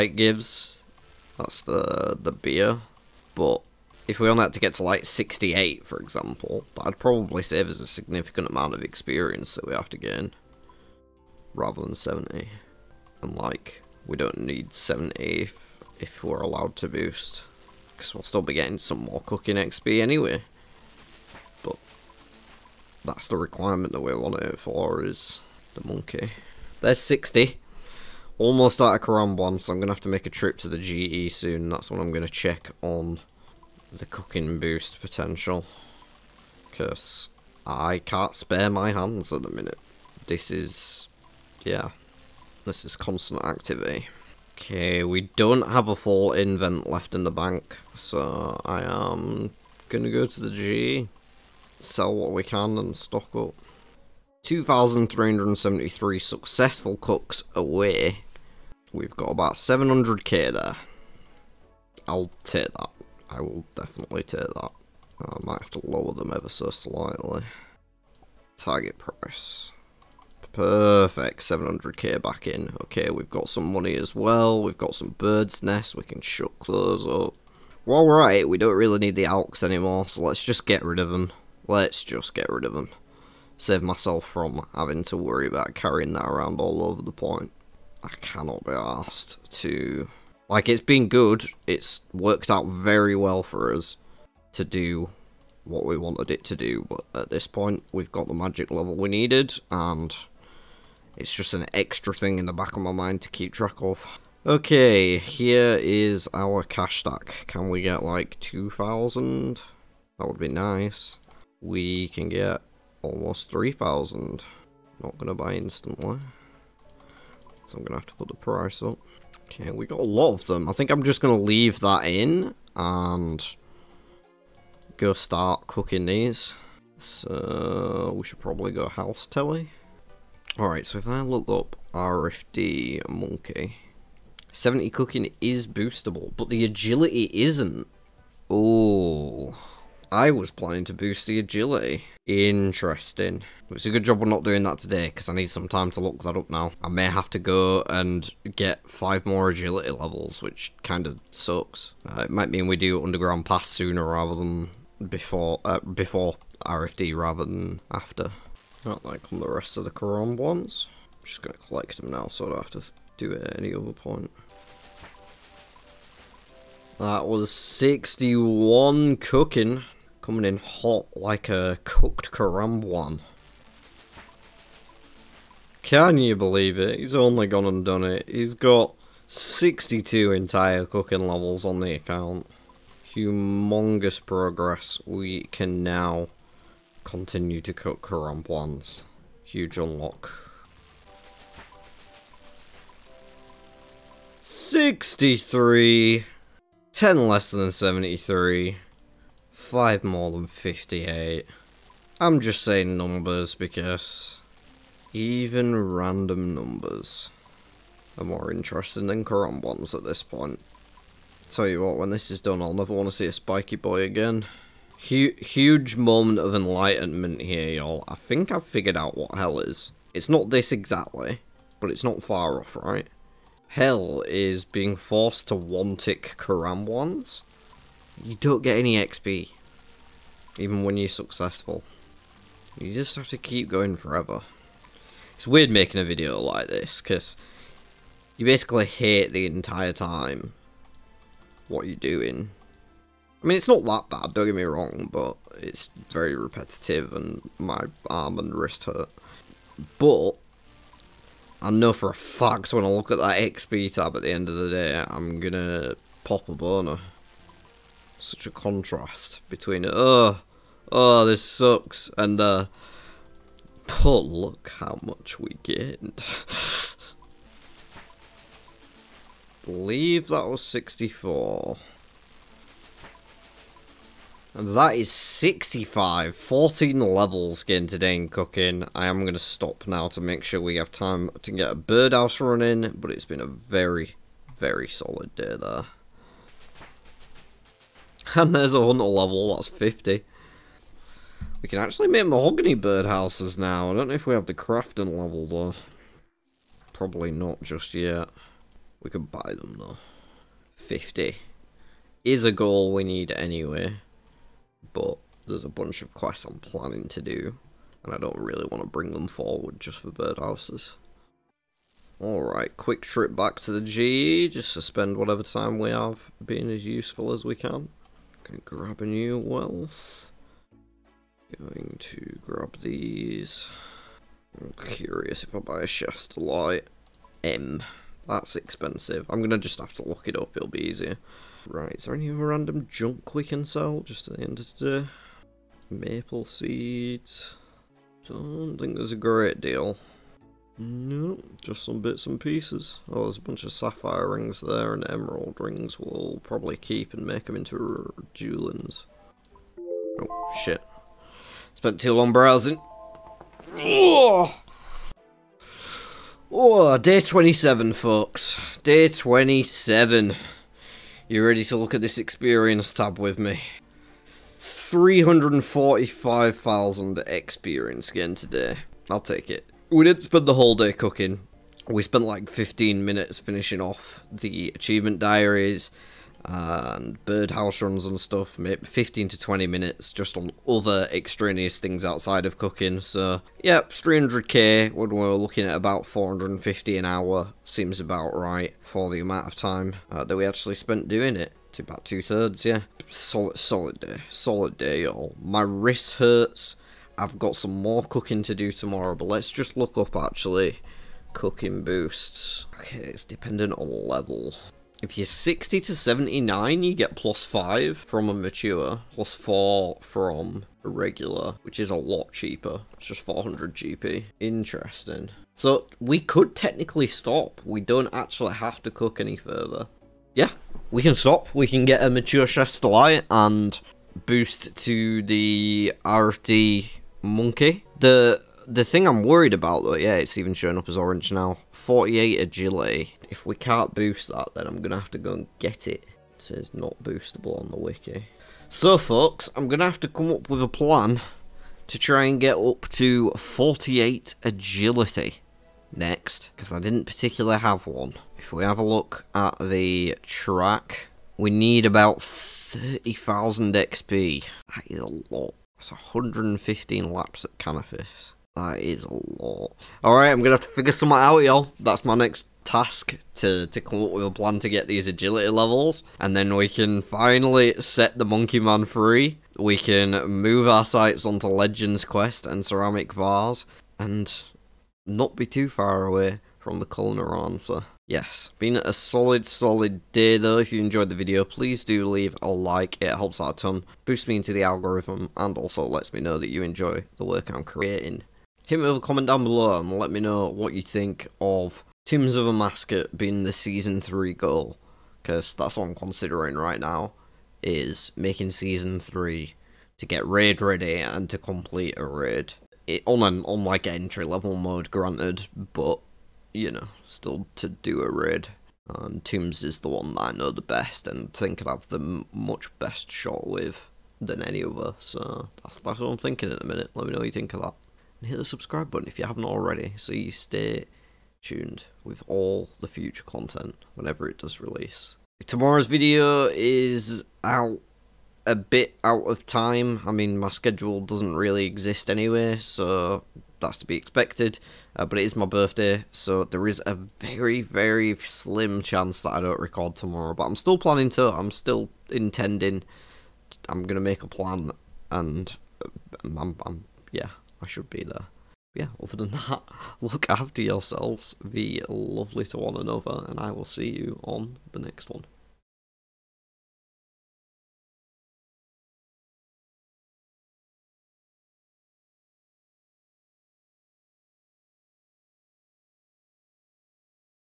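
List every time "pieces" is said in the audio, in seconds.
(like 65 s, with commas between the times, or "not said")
342 s.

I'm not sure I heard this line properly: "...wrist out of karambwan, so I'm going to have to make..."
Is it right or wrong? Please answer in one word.
wrong.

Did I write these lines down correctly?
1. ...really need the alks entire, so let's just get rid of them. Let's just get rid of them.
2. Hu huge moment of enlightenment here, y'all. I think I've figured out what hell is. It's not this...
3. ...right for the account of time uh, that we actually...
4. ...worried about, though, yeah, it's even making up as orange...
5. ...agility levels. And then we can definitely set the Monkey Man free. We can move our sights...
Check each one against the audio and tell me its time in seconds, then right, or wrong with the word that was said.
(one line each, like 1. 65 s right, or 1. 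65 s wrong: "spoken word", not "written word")
1. 78 s wrong: "anymore", not "entire"
2. 215 s right
3. 388 s wrong: "amount", not "account"
4. 429 s wrong: "showing", not "making"
5. 465 s wrong: "finally", not "definitely".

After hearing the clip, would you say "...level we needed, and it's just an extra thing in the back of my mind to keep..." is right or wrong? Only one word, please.
right.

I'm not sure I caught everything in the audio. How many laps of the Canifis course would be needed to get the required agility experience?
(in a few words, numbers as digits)
115.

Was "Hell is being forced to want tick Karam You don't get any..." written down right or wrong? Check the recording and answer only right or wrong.
right.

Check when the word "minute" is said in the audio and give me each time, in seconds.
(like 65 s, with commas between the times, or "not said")
39 s, 373 s, 379 s, 516 s.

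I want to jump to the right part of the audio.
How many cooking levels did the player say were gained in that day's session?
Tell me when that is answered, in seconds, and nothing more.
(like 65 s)
276 s.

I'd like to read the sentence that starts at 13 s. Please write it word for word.
And like, we don't need 70 if, if we're allowed to boost, because we'll still be getting some more cooking XP anyway.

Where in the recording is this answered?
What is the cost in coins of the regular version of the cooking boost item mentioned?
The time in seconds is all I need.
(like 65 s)
413 s.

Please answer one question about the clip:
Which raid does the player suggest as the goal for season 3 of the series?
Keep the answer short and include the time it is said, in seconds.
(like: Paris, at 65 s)
Tombs of Amascut, at 492 s.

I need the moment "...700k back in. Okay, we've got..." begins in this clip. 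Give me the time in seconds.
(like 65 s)
71 s.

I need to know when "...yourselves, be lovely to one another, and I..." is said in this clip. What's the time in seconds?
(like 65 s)
550 s.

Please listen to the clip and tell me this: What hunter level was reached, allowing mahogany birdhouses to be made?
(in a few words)
50.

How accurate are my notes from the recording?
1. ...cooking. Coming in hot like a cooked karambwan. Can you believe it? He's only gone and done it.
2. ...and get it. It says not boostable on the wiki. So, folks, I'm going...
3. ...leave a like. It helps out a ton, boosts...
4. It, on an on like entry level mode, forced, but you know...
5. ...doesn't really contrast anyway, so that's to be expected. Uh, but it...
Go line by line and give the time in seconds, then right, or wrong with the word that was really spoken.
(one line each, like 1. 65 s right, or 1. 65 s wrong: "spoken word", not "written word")
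1. 169 s right
2. 435 s right
3. 482 s right
4. 502 s wrong: "granted", not "forced"
5. 531 s wrong: "exist", not "contrast".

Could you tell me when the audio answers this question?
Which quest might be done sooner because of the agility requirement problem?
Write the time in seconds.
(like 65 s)
153 s.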